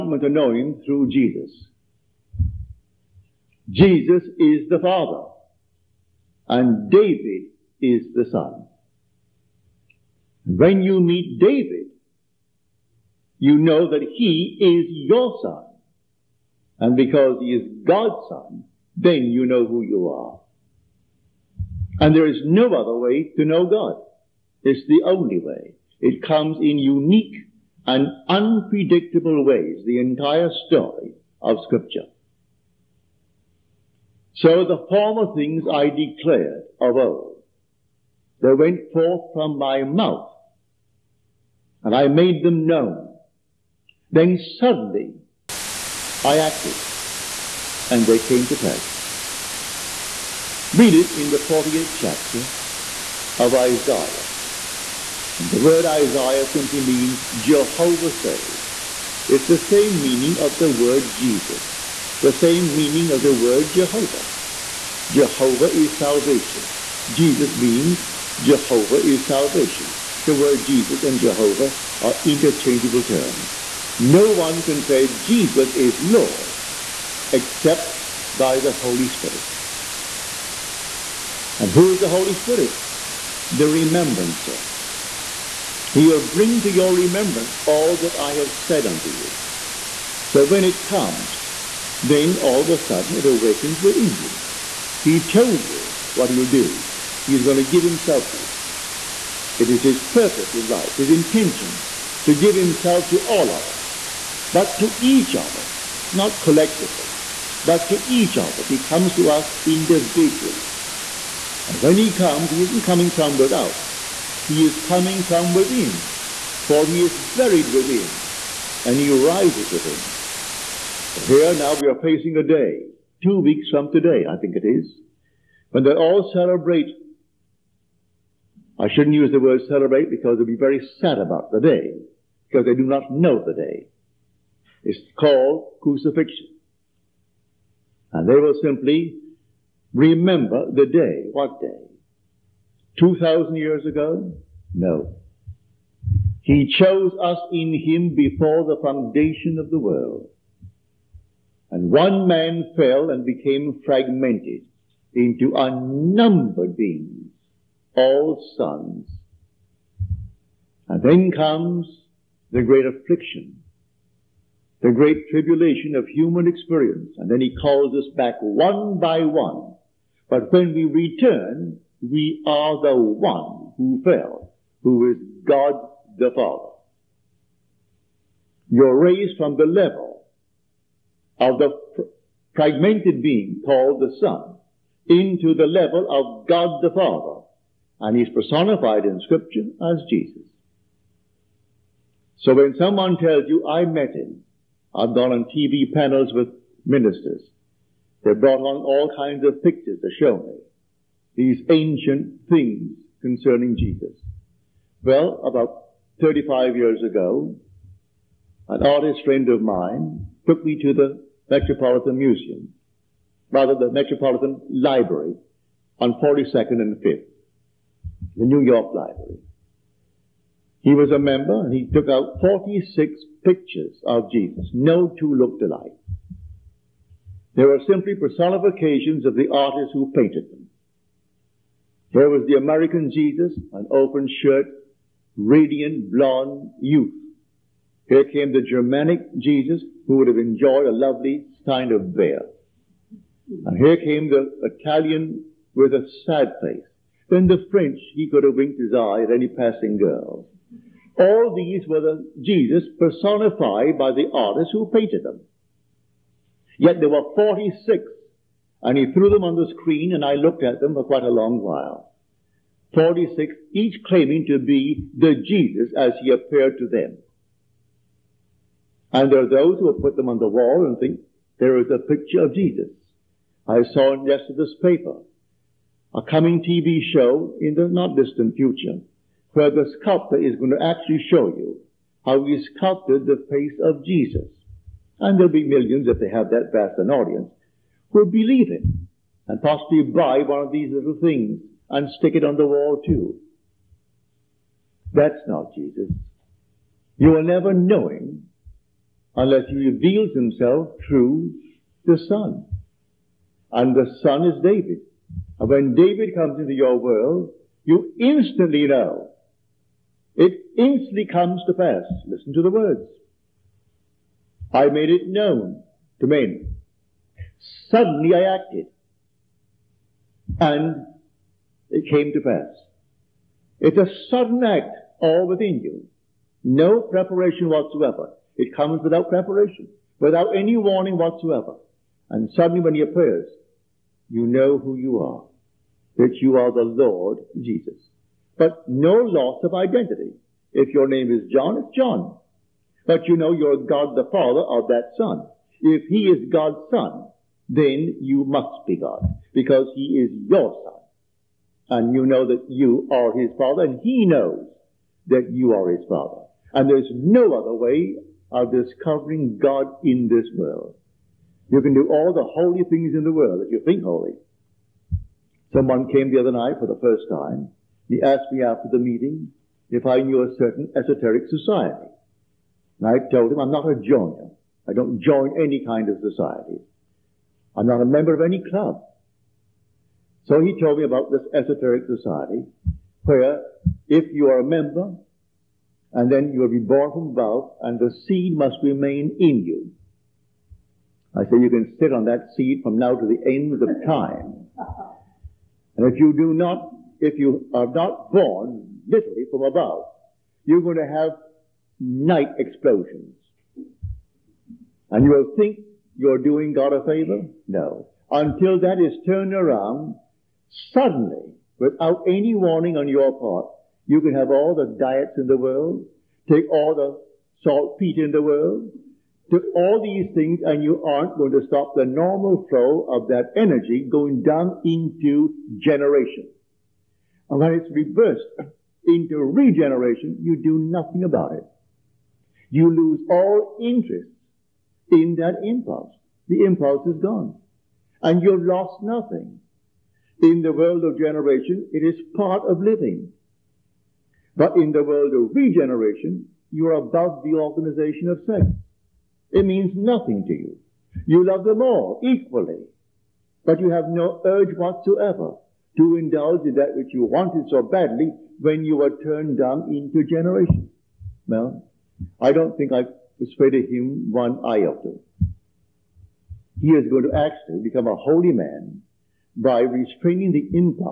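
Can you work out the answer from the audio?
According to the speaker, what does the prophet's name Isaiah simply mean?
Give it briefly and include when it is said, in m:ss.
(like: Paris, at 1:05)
Jehovah saves, at 0:57.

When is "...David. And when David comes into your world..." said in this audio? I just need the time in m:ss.
5:04.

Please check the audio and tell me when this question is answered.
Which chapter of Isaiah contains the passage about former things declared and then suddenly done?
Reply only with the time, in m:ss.
0:51.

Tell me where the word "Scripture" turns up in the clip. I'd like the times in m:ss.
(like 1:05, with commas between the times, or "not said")
0:31, 3:09.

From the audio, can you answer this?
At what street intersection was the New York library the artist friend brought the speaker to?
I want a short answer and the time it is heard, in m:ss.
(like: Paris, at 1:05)
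42nd and 5th, at 3:36.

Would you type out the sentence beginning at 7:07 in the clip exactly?
And when it's reversed into regeneration, you do nothing about it you lose all interest in that impulse.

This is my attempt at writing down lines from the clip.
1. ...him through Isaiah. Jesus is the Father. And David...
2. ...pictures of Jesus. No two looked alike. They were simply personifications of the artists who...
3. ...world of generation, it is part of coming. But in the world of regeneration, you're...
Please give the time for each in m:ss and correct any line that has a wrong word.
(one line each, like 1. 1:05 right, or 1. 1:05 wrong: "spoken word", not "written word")
1. 0:00 wrong: "Jesus", not "Isaiah"
2. 3:43 right
3. 7:20 wrong: "living", not "coming".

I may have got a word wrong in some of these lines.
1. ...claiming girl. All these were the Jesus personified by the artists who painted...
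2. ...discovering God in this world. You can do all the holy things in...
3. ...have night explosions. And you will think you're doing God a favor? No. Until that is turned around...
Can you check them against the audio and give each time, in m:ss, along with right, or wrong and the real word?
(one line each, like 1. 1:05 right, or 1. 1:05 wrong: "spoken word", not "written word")
1. 4:09 wrong: "passing", not "claiming"
2. 5:58 right
3. 6:41 right.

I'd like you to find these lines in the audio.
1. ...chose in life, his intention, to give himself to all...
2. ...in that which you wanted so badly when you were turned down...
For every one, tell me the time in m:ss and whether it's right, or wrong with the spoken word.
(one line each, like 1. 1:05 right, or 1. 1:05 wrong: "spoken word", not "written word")
1. 1:40 wrong: "purpose", not "chose"
2. 7:36 right.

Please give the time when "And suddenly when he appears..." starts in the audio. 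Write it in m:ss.
5:32.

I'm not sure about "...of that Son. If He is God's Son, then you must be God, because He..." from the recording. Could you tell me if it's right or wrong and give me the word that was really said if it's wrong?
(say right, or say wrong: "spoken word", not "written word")
right.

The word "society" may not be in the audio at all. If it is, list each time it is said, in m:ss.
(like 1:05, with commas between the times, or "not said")
6:11, 6:16, 6:22.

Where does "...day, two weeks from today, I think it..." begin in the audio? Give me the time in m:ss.
2:02.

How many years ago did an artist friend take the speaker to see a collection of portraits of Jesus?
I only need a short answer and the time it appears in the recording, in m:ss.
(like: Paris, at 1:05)
35, at 3:26.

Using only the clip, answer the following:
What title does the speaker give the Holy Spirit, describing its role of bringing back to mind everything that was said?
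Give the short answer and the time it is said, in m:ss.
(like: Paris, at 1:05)
The remembrancer, at 1:23.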